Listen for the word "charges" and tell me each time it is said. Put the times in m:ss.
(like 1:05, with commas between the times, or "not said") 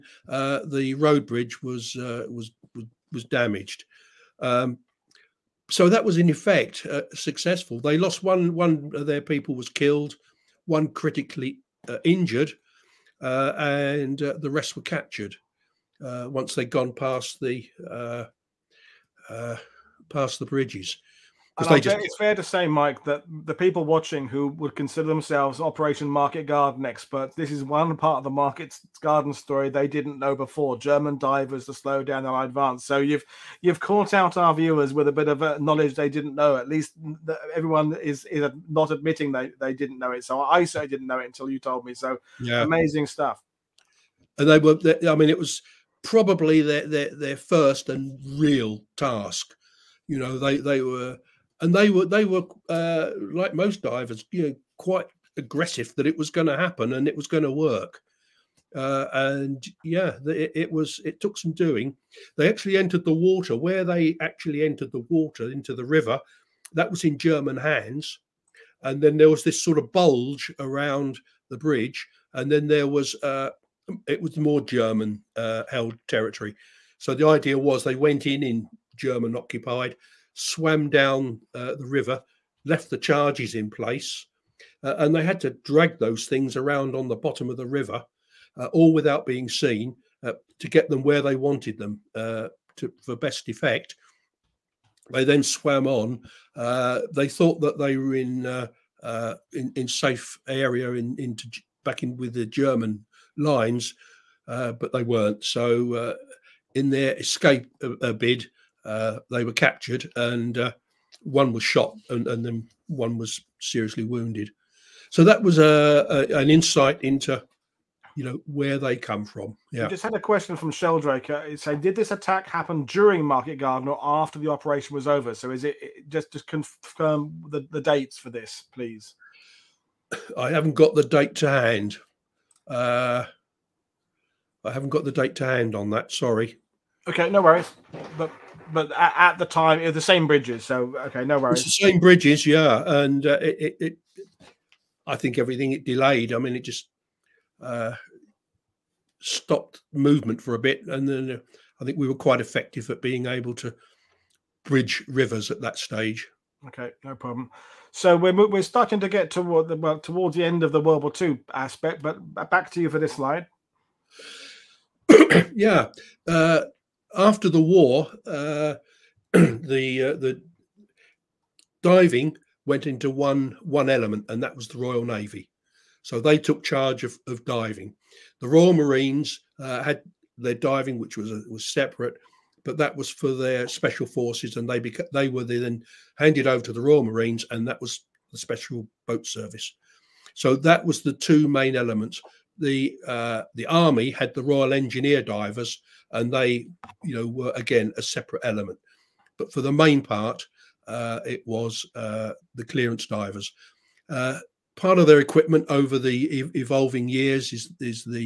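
1:22, 2:56.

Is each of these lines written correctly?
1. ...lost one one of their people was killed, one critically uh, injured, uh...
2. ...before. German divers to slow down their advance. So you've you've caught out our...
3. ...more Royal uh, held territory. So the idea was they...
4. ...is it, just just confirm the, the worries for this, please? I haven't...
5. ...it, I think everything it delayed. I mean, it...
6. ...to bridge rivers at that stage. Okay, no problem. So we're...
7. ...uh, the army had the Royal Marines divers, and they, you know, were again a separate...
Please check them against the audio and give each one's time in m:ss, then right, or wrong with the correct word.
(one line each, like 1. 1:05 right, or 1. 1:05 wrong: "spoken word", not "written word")
1. 0:07 right
2. 0:30 right
3. 1:14 wrong: "German", not "Royal"
4. 2:05 wrong: "dates", not "worries"
5. 2:23 right
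6. 2:33 right
7. 3:13 wrong: "Engineer", not "Marines".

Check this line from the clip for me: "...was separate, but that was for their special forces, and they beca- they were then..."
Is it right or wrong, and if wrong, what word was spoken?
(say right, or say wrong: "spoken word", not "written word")
right.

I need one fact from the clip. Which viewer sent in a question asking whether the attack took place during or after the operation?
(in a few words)
Sheldrake.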